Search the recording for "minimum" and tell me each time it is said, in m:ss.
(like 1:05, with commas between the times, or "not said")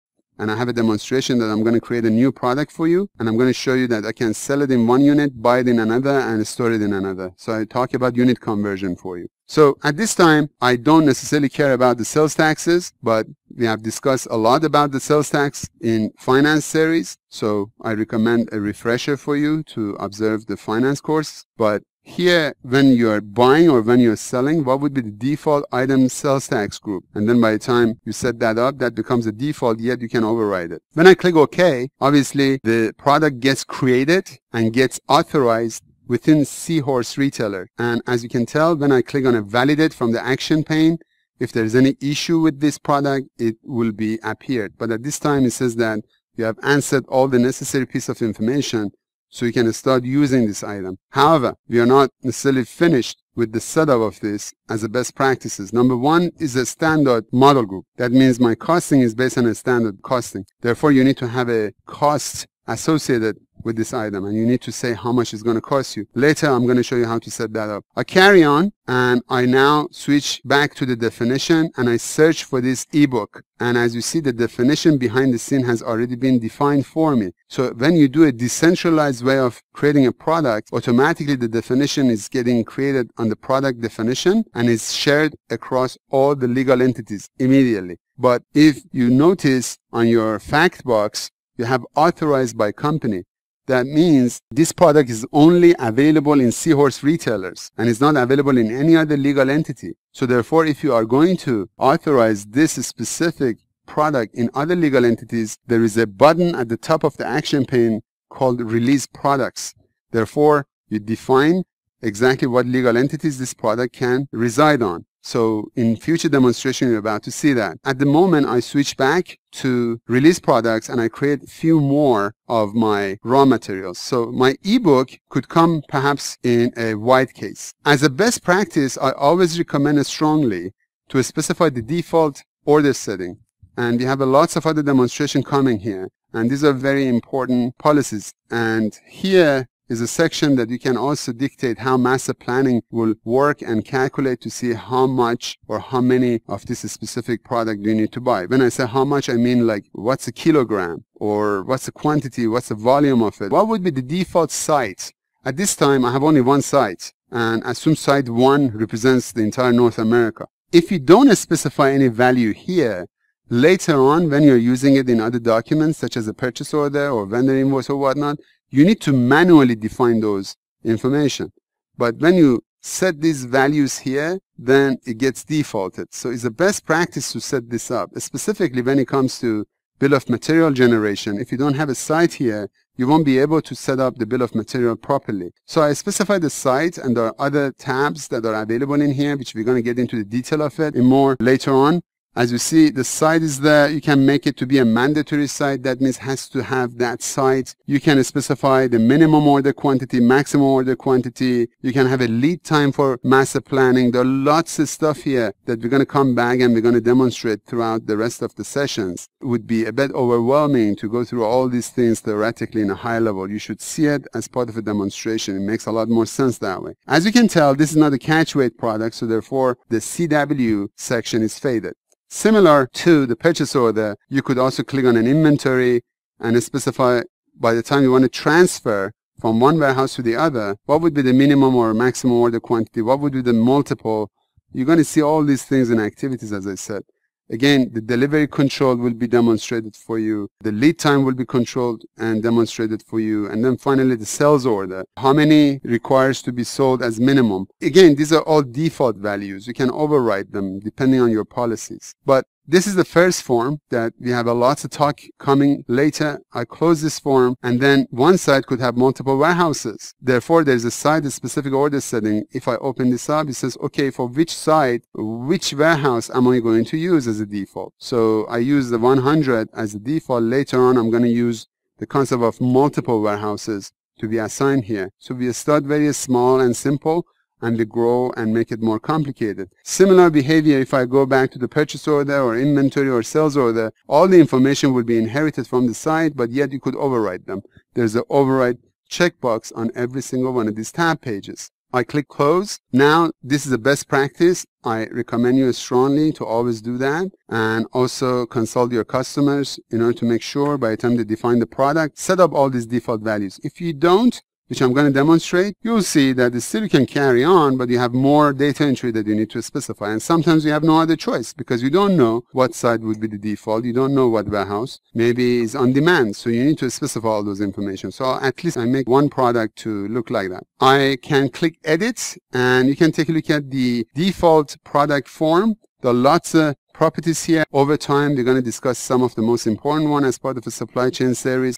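3:18, 3:51, 4:07.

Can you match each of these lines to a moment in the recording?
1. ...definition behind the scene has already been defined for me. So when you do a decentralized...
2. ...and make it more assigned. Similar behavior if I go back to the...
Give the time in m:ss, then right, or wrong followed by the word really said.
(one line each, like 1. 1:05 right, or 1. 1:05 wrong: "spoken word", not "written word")
1. 1:14 right
2. 4:38 wrong: "complicated", not "assigned".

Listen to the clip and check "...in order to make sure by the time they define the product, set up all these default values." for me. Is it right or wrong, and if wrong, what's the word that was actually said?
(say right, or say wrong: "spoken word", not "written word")
right.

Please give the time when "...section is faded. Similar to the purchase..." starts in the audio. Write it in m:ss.
3:40.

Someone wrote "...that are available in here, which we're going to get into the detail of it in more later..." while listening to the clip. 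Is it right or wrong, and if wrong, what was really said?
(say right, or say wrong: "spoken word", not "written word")
right.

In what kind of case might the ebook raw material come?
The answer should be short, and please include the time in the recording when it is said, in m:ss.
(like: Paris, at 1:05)
A white case, at 2:06.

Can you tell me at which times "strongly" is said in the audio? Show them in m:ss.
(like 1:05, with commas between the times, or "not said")
2:10, 4:55.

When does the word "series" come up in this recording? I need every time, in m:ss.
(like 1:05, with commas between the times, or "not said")
0:16, 5:31.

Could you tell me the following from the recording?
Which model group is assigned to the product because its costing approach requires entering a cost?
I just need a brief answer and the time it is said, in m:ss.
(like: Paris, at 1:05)
Standard model group, at 0:56.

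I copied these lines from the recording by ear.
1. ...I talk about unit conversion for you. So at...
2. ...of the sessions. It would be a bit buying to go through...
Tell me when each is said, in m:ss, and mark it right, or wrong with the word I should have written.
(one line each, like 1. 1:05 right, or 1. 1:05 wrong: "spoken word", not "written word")
1. 0:07 right
2. 3:28 wrong: "overwhelming", not "buying".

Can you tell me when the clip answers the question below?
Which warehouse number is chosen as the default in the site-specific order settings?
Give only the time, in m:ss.
4:28.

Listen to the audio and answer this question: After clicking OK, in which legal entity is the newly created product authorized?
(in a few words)
Seahorse Retailer.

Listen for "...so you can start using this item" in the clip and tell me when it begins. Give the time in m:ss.
0:49.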